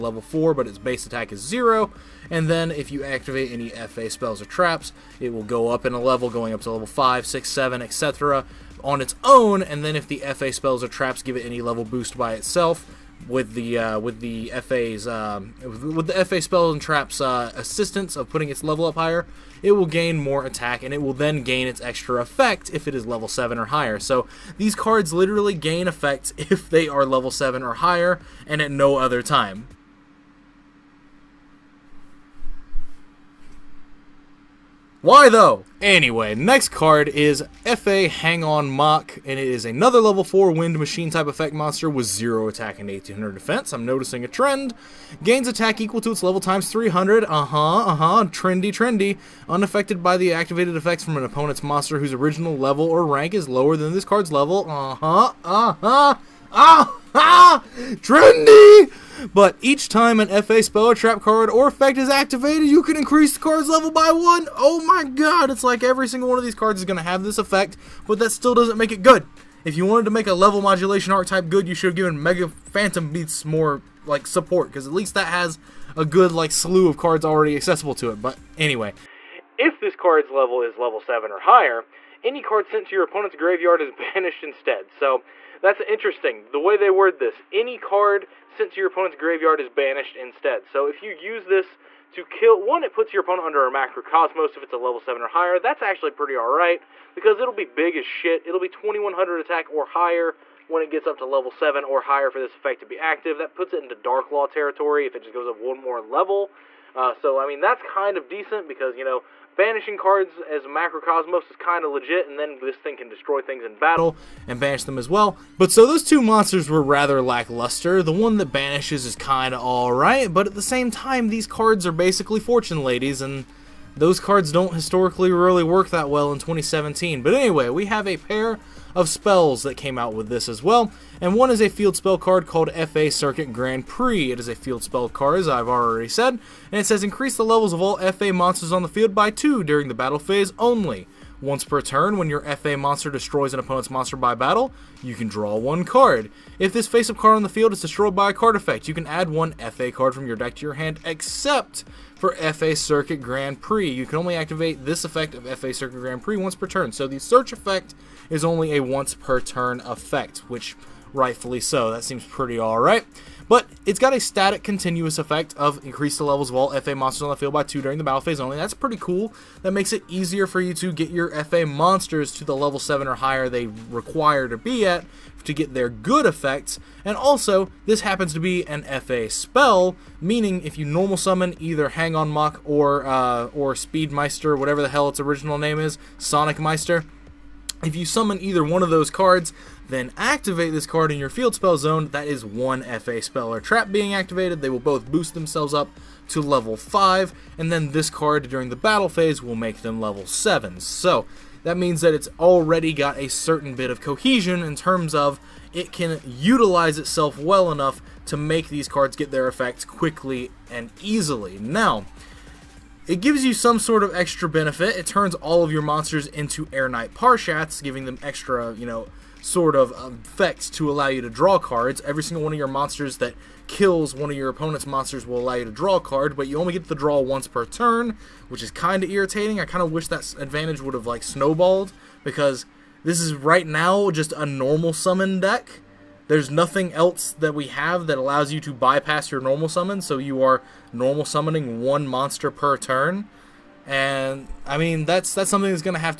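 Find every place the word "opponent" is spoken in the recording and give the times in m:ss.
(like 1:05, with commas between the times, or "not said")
0:51, 1:23, 1:28, 1:33, 2:23, 3:44.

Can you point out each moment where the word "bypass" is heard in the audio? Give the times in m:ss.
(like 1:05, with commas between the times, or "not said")
3:58.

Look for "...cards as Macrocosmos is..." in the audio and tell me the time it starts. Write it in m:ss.
1:49.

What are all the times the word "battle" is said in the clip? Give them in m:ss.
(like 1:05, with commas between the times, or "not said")
1:53, 2:19, 2:24, 2:48, 3:18.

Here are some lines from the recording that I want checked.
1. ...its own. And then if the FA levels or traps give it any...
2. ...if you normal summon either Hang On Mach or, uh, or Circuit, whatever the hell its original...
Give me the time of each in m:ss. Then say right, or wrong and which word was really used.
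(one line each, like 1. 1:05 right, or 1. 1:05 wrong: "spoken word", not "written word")
1. 0:09 wrong: "spells", not "levels"
2. 3:00 wrong: "Speedmeister", not "Circuit".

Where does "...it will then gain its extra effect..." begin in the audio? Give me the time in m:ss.
0:20.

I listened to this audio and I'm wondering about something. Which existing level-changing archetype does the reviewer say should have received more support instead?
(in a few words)
Mecha Phantom Beasts.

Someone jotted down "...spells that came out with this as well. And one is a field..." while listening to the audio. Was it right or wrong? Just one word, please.
right.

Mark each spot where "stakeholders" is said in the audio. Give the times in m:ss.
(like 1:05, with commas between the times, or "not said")
not said.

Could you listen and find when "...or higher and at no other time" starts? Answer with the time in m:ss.
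0:27.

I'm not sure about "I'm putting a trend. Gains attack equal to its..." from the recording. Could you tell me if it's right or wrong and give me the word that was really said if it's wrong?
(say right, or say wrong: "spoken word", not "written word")
wrong: "noticing", not "putting".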